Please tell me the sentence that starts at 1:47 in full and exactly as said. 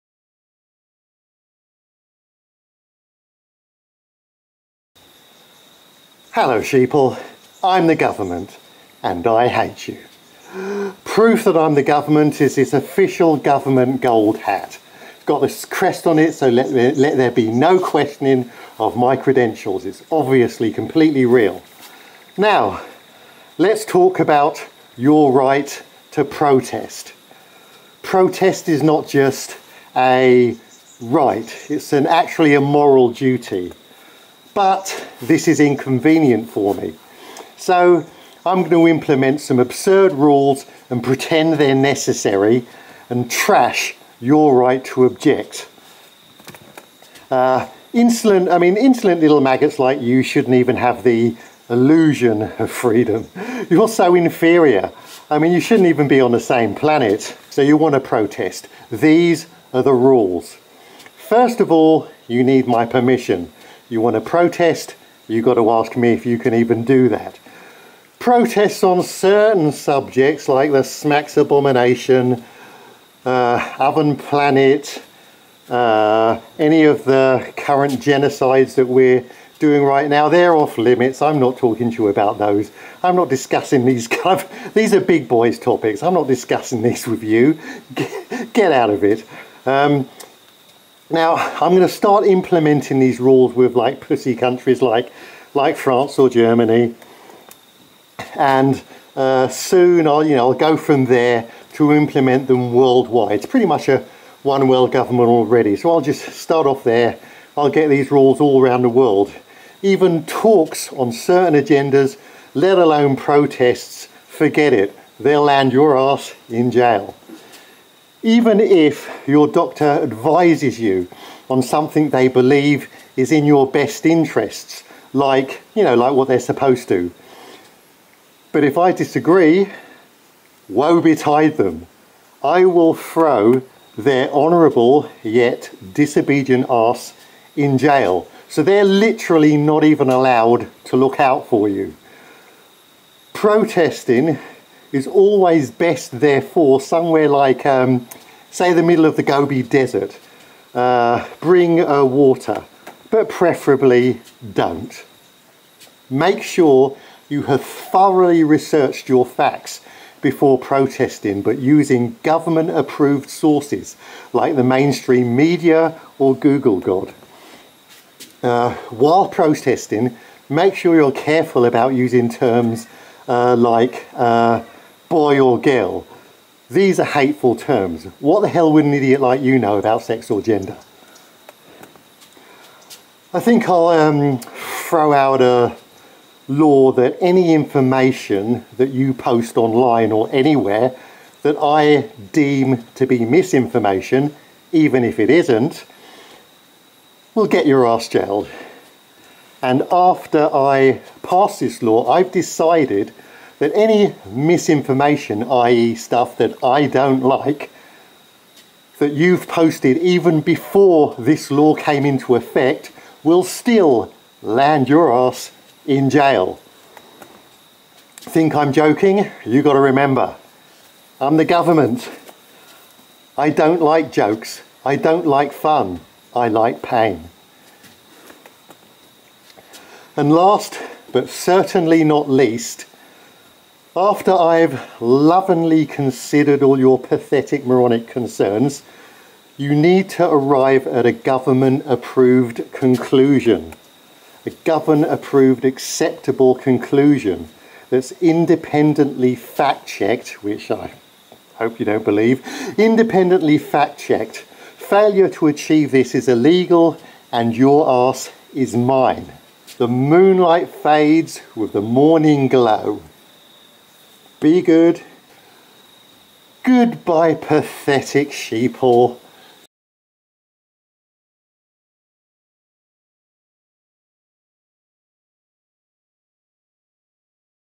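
I'll get these rules all around the world.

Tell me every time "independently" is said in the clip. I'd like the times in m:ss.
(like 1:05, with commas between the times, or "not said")
4:08, 4:12.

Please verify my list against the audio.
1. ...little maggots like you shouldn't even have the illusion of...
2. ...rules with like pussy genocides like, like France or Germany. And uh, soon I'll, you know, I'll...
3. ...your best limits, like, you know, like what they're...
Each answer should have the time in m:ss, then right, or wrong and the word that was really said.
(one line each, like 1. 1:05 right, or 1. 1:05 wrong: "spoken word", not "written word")
1. 0:49 right
2. 1:33 wrong: "countries", not "genocides"
3. 2:03 wrong: "interests", not "limits".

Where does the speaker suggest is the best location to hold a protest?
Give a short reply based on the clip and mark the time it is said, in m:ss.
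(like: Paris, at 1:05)
Gobi Desert, at 2:29.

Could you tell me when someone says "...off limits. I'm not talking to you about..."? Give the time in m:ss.
1:20.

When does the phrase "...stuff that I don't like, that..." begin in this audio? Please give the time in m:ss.
3:25.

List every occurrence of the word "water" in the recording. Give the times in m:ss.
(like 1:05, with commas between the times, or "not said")
2:32.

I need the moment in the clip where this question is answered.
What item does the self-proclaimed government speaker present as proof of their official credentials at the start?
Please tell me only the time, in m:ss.
0:12.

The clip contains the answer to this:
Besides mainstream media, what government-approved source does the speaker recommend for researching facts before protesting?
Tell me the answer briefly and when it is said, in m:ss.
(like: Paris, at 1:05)
Google God, at 2:46.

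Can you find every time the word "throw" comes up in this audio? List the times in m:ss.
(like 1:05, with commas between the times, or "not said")
2:12, 3:04.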